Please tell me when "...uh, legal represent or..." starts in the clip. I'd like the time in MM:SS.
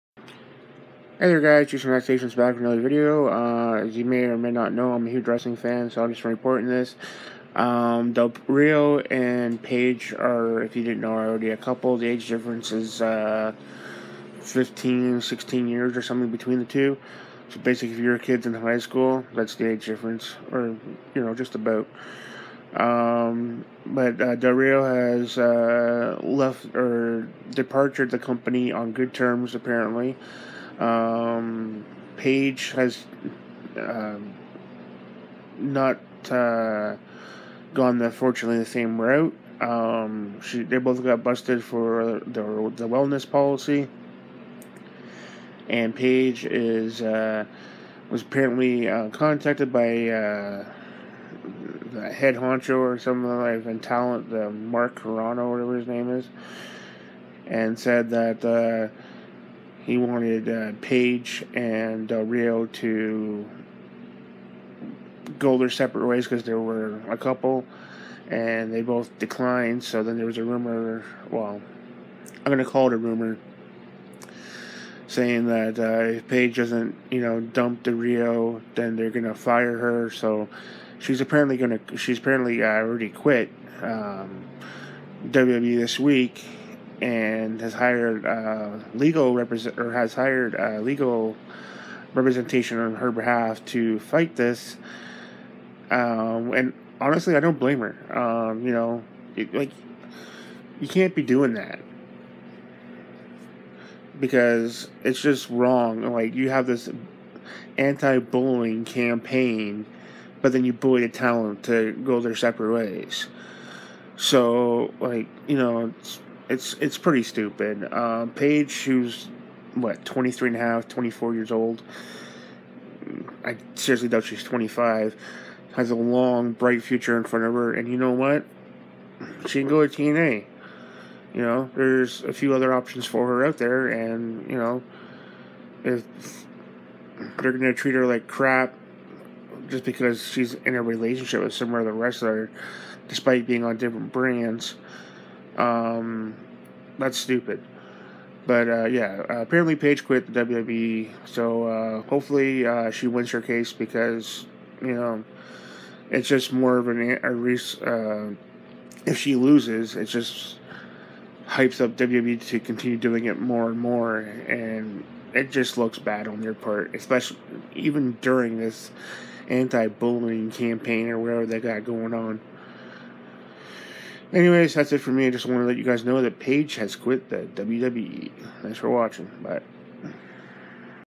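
01:28.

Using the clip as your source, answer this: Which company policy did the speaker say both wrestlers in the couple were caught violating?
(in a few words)
the wellness policy.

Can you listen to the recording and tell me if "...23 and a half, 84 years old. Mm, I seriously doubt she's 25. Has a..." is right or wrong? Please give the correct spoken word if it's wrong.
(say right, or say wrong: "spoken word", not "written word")
wrong: "24", not "84".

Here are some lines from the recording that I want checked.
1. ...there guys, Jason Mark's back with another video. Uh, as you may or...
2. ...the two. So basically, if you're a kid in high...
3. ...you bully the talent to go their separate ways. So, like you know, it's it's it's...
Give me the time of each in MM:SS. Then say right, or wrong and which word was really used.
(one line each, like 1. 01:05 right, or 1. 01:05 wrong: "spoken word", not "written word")
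1. 00:01 wrong: "Relaxation", not "Mark"
2. 00:16 right
3. 01:50 right.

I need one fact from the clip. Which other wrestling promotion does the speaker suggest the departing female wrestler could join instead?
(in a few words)
TNA.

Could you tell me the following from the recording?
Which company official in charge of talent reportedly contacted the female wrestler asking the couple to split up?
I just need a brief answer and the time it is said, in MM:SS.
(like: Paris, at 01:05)
Mark Carrano, at 00:54.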